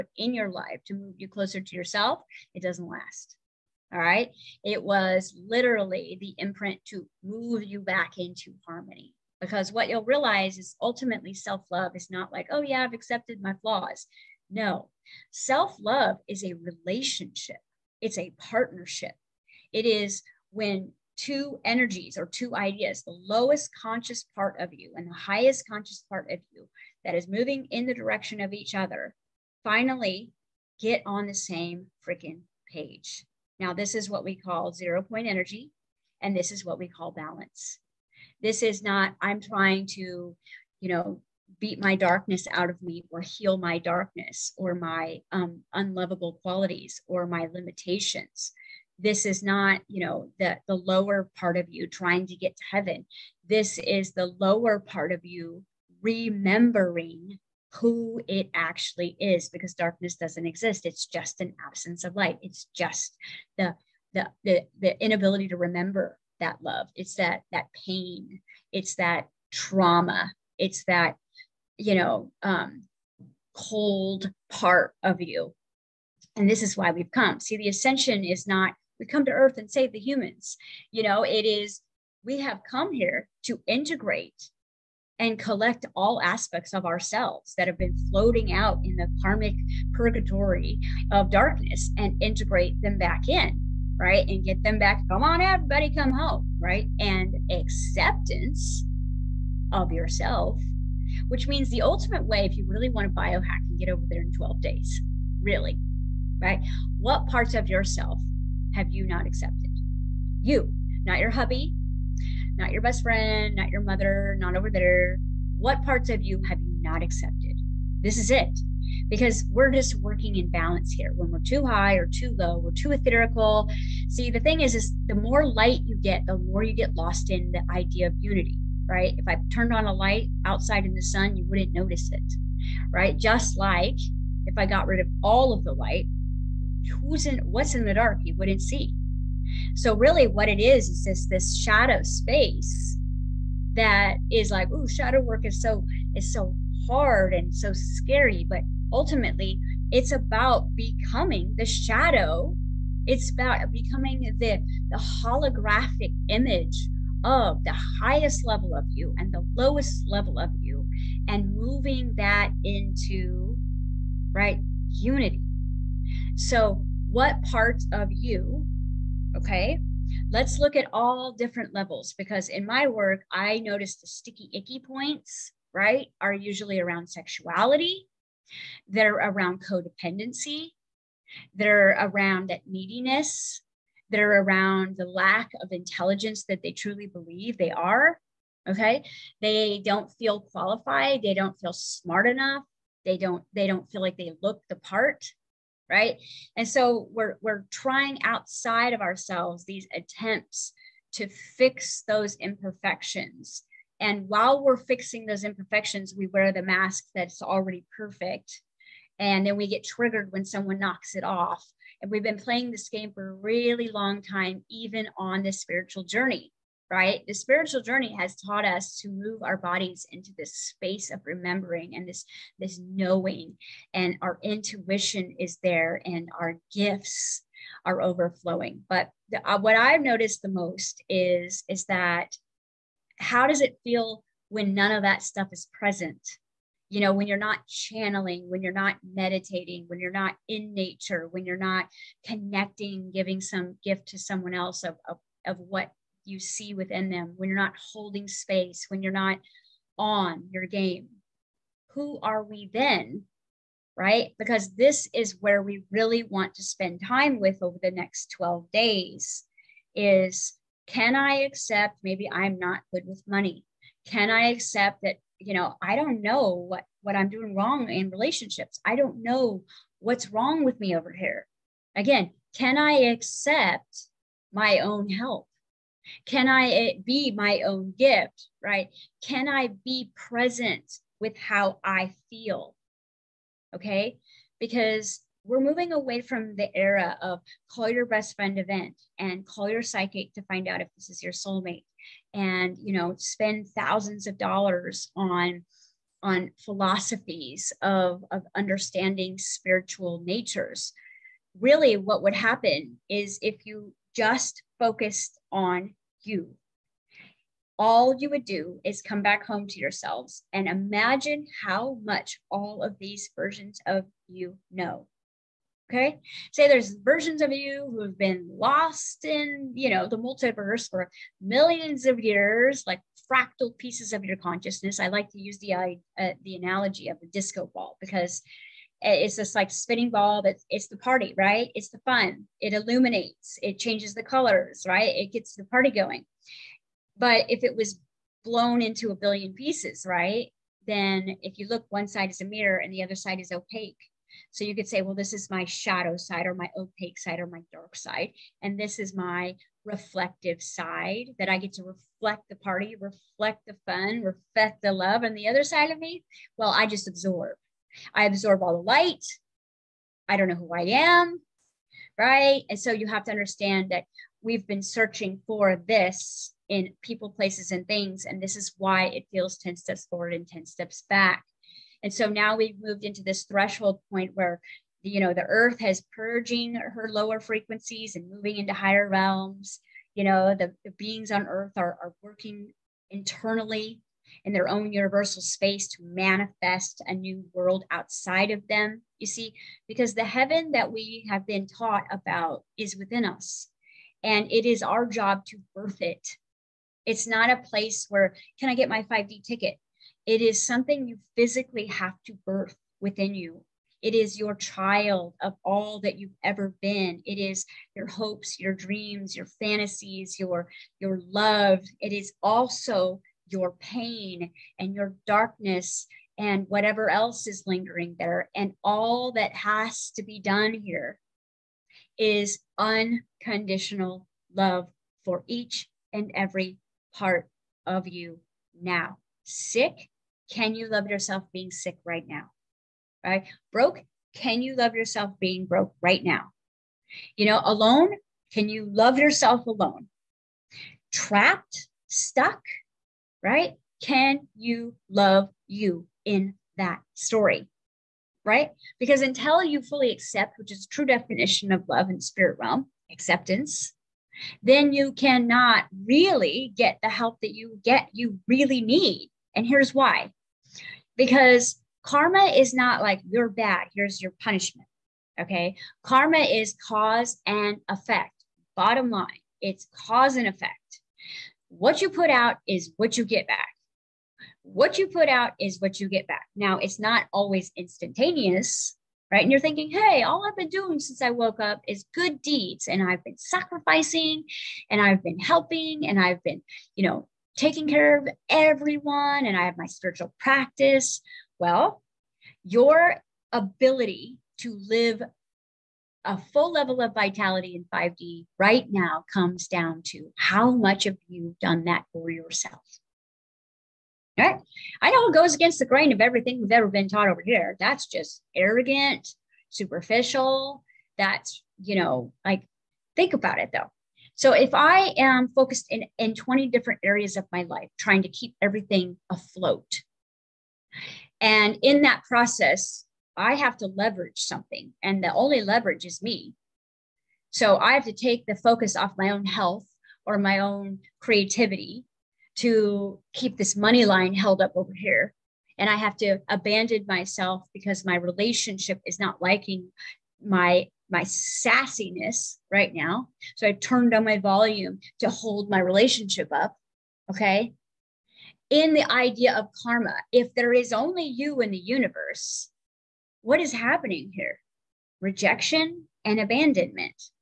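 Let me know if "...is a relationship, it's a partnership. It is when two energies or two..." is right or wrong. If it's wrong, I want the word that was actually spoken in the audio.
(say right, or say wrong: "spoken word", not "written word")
right.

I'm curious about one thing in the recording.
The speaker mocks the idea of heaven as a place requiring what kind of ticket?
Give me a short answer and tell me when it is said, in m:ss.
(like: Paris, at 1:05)
5D ticket, at 6:39.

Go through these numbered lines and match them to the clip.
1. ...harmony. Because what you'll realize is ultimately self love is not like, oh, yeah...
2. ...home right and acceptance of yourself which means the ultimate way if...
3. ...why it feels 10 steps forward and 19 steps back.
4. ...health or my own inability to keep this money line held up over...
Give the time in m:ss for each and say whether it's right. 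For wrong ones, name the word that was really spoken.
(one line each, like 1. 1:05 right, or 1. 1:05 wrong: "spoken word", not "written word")
1. 0:08 right
2. 1:36 right
3. 6:08 wrong: "10", not "19"
4. 8:49 wrong: "creativity", not "inability".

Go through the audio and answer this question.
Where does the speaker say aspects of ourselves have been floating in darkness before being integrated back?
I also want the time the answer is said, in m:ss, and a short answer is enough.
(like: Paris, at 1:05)
Karmic purgatory, at 1:29.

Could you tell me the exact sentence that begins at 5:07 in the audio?
All you would do is come back home to yourselves and imagine how much all of these versions of you know.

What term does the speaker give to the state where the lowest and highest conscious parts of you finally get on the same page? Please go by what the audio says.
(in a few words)
Zero point energy.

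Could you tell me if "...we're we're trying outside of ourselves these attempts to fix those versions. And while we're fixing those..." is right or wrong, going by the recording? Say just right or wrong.
wrong.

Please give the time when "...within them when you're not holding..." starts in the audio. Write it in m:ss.
4:06.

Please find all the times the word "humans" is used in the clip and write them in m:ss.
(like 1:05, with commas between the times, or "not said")
1:19.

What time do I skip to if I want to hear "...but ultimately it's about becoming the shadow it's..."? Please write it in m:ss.
2:28.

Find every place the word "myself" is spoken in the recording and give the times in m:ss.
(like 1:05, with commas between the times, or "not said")
8:57.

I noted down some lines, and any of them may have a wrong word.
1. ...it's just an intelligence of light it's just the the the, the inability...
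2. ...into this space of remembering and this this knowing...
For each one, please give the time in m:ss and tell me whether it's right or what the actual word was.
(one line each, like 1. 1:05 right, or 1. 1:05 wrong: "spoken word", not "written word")
1. 1:00 wrong: "absence", not "intelligence"
2. 3:40 right.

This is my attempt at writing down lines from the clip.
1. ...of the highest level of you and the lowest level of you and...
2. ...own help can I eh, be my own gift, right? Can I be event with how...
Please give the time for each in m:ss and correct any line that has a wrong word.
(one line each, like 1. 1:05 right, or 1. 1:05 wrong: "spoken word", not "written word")
1. 2:37 right
2. 4:34 wrong: "present", not "event".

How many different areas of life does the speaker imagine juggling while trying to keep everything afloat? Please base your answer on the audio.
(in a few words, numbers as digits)
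20.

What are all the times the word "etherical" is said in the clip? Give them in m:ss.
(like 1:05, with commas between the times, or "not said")
2:02.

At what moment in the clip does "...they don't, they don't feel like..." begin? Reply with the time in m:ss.
3:13.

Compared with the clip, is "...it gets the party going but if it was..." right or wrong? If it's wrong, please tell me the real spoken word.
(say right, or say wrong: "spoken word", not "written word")
right.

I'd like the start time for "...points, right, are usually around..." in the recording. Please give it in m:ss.
2:54.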